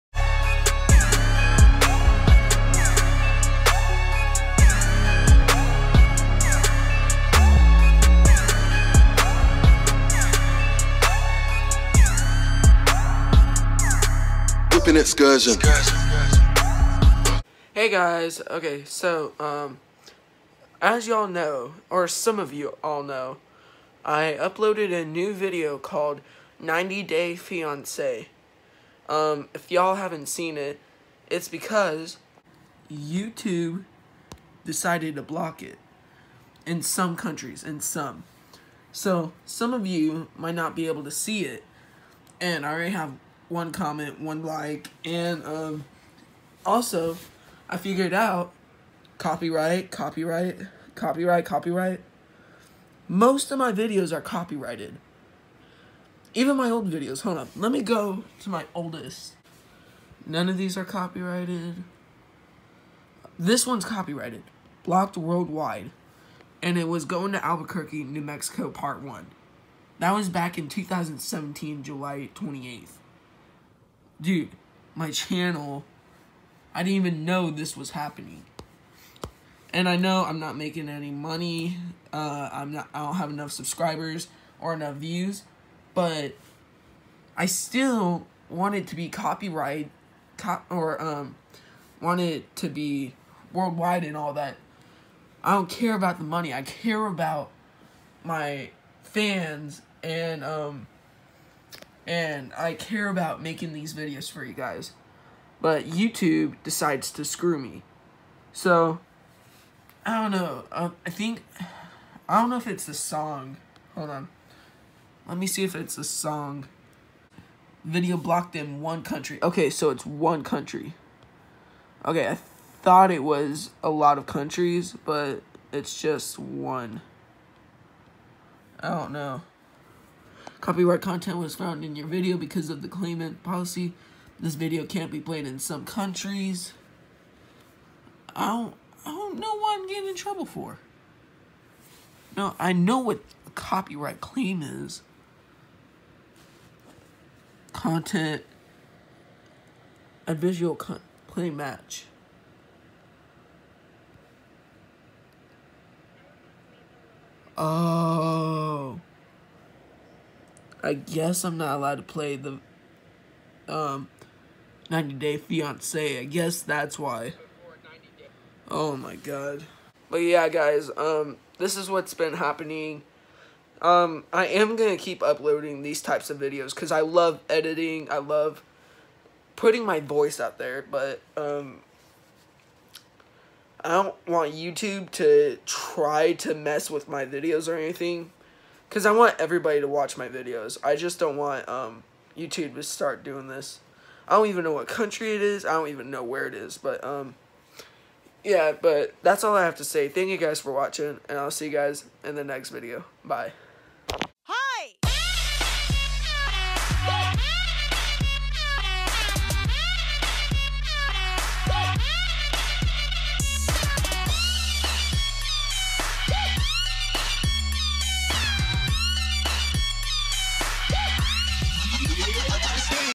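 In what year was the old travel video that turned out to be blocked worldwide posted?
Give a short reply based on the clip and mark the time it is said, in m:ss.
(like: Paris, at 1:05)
2017, at 1:10.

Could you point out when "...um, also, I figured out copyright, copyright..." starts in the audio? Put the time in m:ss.
0:45.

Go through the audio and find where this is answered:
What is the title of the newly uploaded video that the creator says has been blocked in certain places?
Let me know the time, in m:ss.
0:26.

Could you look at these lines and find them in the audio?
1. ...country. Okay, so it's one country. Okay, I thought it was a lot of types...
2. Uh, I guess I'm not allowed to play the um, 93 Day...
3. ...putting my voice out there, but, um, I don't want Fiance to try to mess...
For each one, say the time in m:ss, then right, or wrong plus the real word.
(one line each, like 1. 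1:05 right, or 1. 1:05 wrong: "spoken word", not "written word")
1. 1:59 wrong: "countries", not "types"
2. 2:37 wrong: "90", not "93"
3. 2:59 wrong: "YouTube", not "Fiance".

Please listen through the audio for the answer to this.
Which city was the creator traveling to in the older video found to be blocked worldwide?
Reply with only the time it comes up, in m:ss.
1:07.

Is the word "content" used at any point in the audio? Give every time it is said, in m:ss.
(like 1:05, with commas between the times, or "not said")
2:11, 2:27.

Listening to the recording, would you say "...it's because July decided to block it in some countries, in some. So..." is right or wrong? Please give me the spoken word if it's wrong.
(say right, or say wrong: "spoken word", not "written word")
wrong: "YouTube", not "July".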